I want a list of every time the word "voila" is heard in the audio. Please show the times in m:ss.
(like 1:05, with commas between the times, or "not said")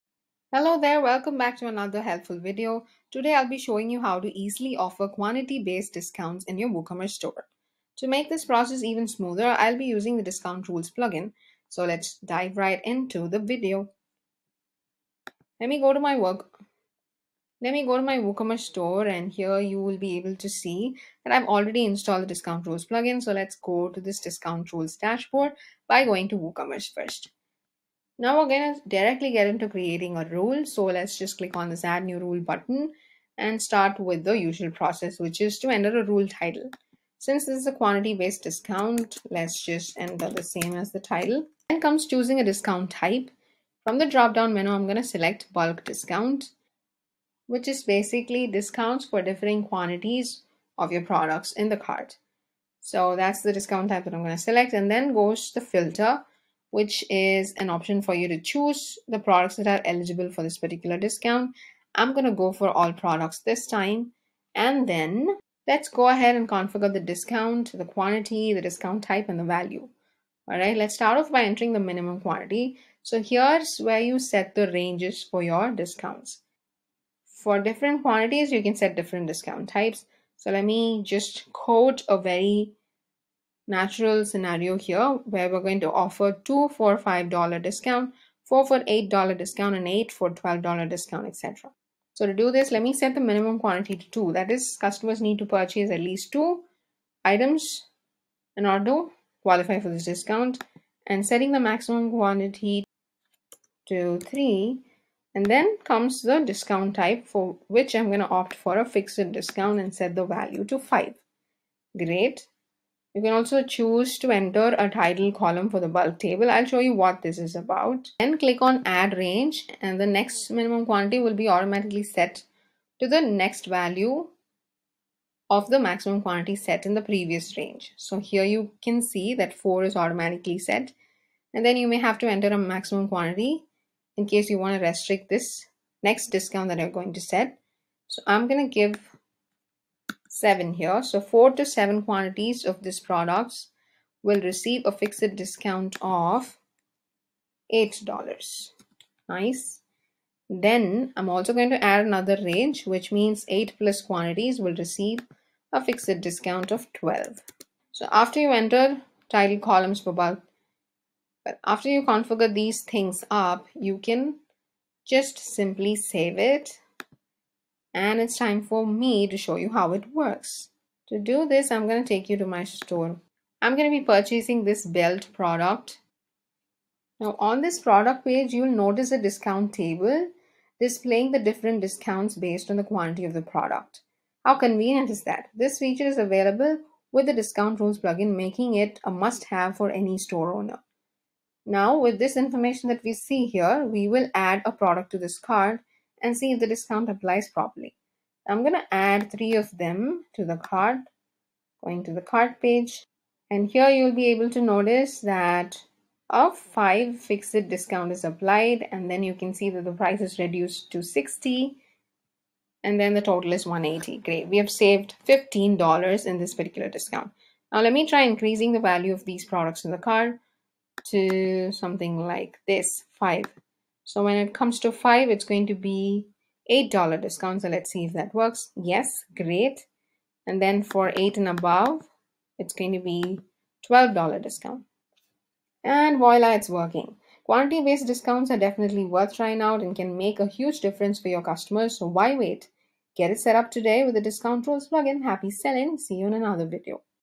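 3:56.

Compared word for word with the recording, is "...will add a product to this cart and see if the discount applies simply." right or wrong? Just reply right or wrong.
wrong.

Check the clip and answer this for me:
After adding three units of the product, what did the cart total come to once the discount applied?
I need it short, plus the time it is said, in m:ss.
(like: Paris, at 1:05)
180, at 3:33.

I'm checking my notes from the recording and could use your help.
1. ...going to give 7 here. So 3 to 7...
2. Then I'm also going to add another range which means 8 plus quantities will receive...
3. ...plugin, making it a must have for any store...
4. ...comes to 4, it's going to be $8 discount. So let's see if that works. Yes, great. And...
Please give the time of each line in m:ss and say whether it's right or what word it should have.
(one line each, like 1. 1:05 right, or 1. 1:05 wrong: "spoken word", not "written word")
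1. 2:18 wrong: "4", not "3"
2. 2:30 right
3. 3:07 right
4. 3:44 wrong: "5", not "4".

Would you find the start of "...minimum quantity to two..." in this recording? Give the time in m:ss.
1:33.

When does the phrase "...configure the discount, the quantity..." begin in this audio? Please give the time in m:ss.
1:06.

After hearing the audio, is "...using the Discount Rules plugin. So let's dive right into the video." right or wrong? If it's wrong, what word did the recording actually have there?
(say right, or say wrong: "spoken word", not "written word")
right.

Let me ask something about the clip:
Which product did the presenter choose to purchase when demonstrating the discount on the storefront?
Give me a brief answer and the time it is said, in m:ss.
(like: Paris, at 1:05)
belt, at 2:54.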